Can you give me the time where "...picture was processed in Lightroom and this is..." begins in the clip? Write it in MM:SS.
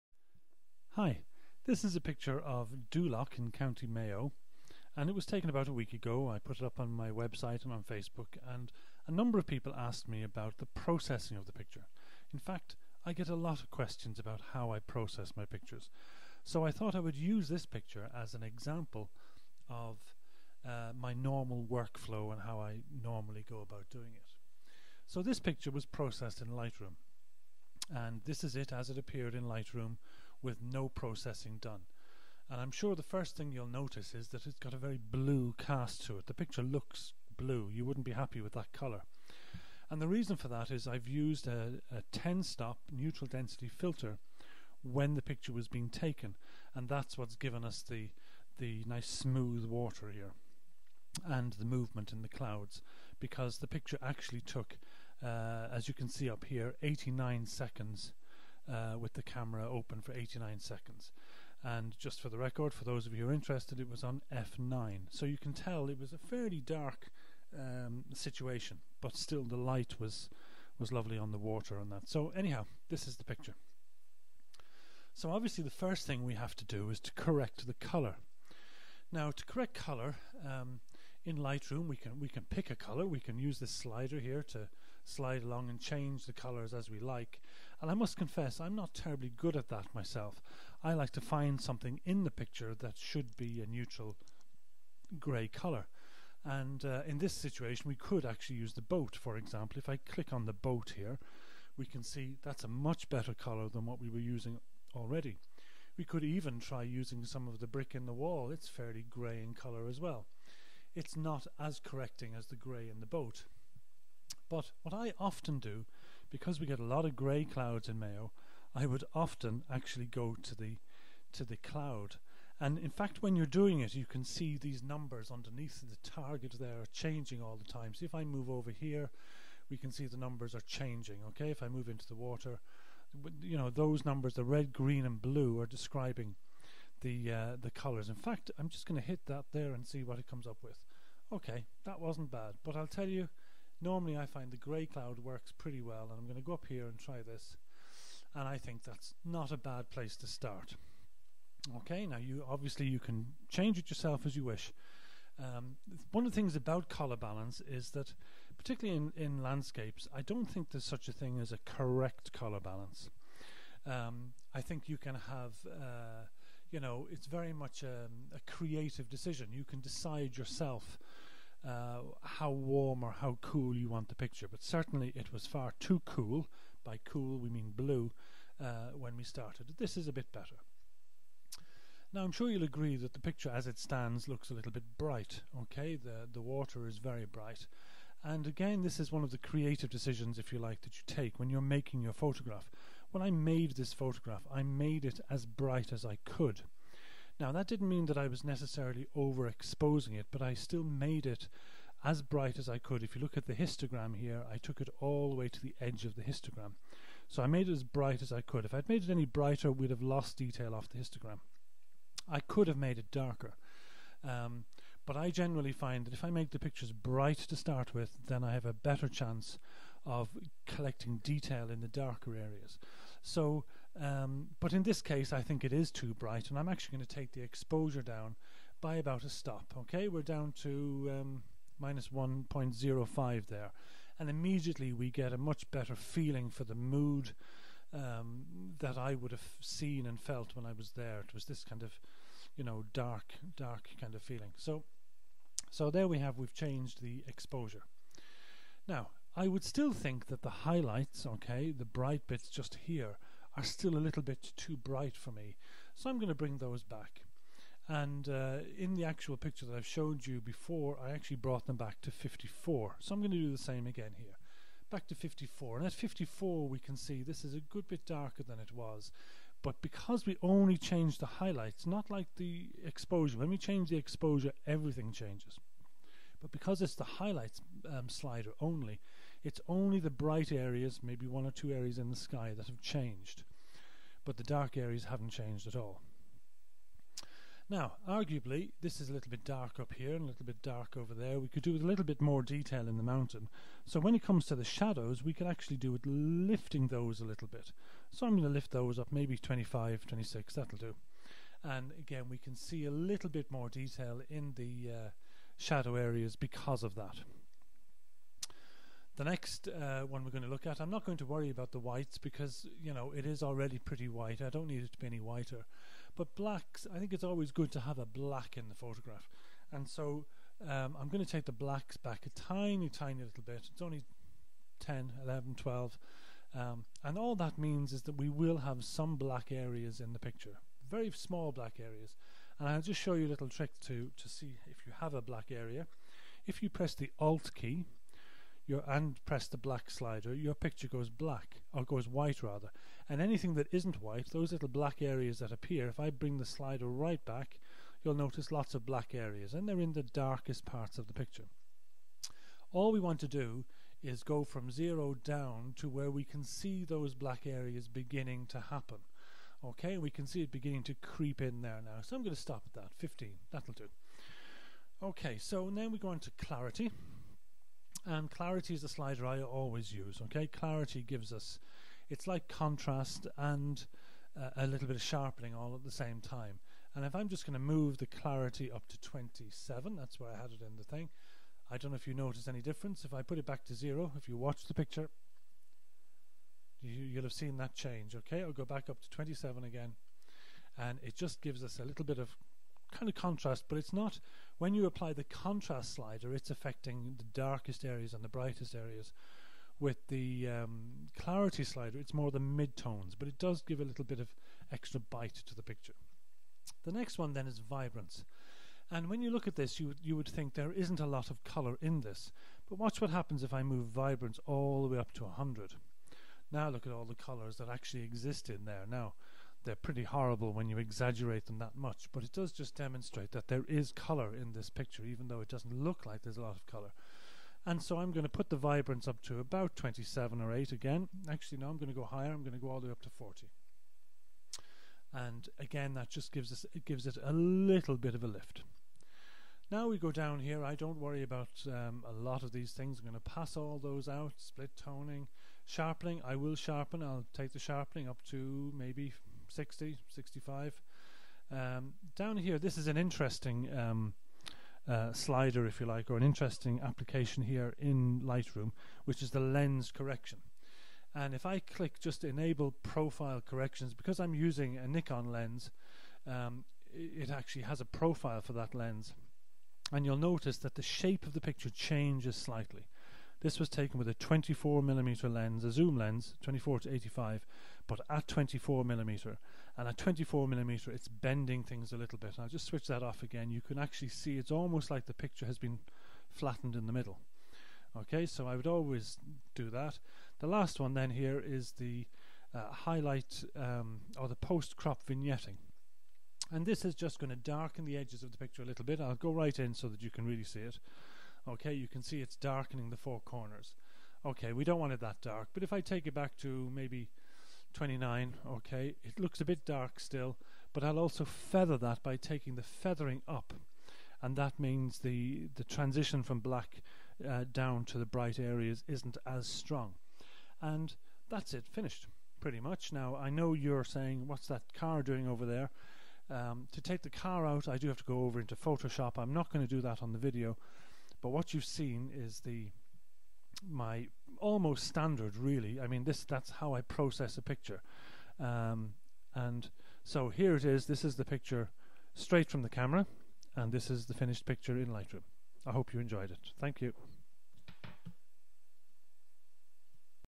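00:25.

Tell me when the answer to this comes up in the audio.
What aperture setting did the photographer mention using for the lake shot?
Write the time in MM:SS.
01:04.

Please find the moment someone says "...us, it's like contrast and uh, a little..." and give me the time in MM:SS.
06:11.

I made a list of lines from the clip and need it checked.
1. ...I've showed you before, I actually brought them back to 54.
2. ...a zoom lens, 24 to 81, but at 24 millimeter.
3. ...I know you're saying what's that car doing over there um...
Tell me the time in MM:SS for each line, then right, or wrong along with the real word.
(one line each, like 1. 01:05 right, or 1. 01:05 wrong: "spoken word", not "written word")
1. 04:19 right
2. 07:55 wrong: "85", not "81"
3. 08:43 right.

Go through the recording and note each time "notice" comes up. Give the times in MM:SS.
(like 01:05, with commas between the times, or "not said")
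00:33, 05:48, 06:22, 07:50.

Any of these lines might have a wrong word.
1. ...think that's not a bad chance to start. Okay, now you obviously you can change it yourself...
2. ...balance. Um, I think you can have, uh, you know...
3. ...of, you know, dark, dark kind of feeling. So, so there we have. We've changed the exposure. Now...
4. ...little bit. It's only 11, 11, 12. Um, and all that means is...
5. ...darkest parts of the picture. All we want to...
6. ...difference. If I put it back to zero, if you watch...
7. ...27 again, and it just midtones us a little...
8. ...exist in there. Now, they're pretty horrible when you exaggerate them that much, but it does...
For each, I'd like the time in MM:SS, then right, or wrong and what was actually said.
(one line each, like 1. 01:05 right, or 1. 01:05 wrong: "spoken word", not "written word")
1. 02:28 wrong: "place", not "chance"
2. 02:42 right
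3. 04:01 right
4. 05:23 wrong: "10", not "11"
5. 05:50 right
6. 06:22 right
7. 06:29 wrong: "gives", not "midtones"
8. 06:58 right.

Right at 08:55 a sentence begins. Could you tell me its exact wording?
I mean, this that's how I process a picture.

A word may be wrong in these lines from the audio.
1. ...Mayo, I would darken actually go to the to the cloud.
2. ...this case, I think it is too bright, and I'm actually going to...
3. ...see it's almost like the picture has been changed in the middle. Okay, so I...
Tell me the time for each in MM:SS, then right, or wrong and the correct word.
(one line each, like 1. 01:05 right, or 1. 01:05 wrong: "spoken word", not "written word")
1. 01:57 wrong: "often", not "darken"
2. 03:44 right
3. 08:04 wrong: "flattened", not "changed".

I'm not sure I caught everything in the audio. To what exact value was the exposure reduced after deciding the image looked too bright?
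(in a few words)
-1.05.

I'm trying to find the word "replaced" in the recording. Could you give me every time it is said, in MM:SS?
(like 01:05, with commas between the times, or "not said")
not said.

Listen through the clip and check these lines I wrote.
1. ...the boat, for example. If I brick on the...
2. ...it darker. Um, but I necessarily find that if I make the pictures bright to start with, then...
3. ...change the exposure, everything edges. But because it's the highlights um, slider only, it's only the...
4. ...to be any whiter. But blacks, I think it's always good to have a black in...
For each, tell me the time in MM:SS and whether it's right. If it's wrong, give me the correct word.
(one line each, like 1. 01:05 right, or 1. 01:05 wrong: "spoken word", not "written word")
1. 01:38 wrong: "click", not "brick"
2. 03:32 wrong: "generally", not "necessarily"
3. 04:33 wrong: "changes", not "edges"
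4. 05:14 right.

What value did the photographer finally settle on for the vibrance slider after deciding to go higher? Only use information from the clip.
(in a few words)
40.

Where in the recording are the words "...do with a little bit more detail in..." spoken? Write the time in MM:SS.
04:51.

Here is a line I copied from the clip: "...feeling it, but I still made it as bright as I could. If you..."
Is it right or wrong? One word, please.
wrong.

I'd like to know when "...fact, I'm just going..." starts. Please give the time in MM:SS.
02:18.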